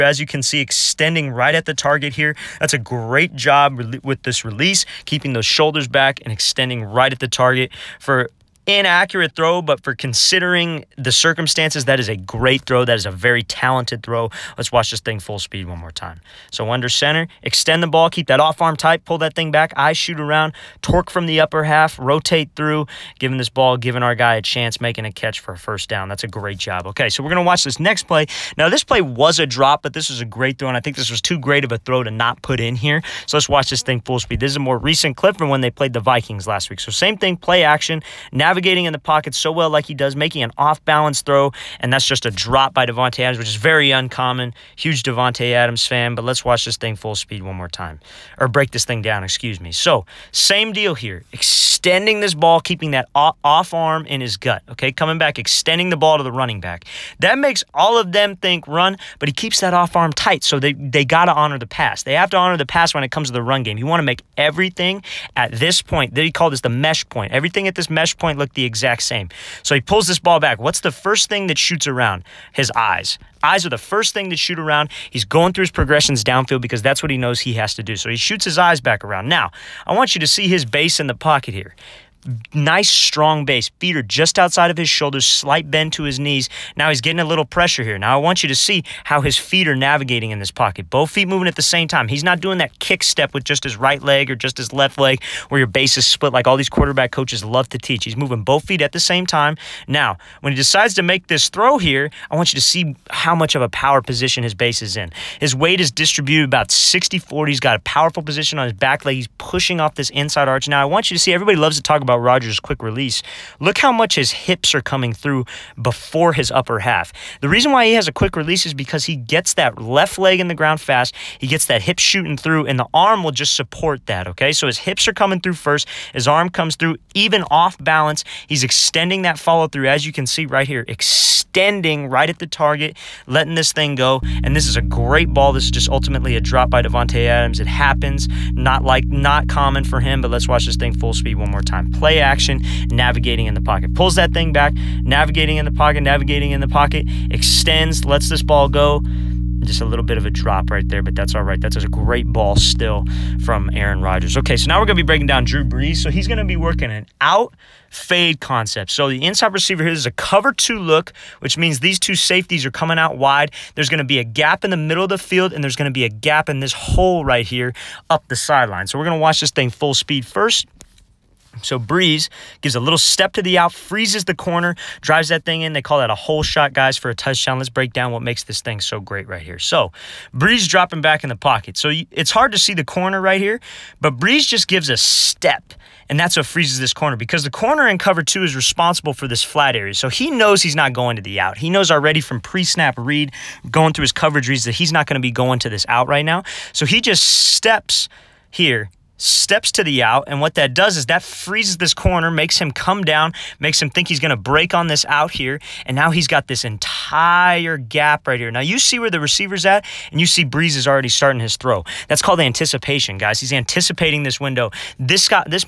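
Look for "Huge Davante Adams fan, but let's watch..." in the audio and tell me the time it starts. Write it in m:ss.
0:44.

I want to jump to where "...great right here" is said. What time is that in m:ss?
2:58.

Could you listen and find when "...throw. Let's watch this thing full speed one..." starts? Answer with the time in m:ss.
0:14.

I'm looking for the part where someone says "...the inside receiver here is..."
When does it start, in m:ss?
2:39.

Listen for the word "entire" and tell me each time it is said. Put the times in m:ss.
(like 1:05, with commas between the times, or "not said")
3:26.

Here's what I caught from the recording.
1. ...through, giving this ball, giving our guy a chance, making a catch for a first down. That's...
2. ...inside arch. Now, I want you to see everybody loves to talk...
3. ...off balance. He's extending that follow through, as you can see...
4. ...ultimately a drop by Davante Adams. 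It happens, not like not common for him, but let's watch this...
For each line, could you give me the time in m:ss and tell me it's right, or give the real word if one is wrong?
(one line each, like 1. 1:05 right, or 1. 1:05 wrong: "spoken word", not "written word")
1. 0:22 right
2. 1:50 right
3. 2:07 right
4. 2:15 right.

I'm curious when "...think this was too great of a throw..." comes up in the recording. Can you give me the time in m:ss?
0:30.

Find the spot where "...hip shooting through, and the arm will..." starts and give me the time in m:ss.
2:01.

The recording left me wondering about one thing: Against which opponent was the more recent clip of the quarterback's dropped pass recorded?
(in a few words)
Vikings.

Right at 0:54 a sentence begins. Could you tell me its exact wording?
Coming back, extending the ball to the running back.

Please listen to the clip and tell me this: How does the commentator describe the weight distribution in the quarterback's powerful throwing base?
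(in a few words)
60-40.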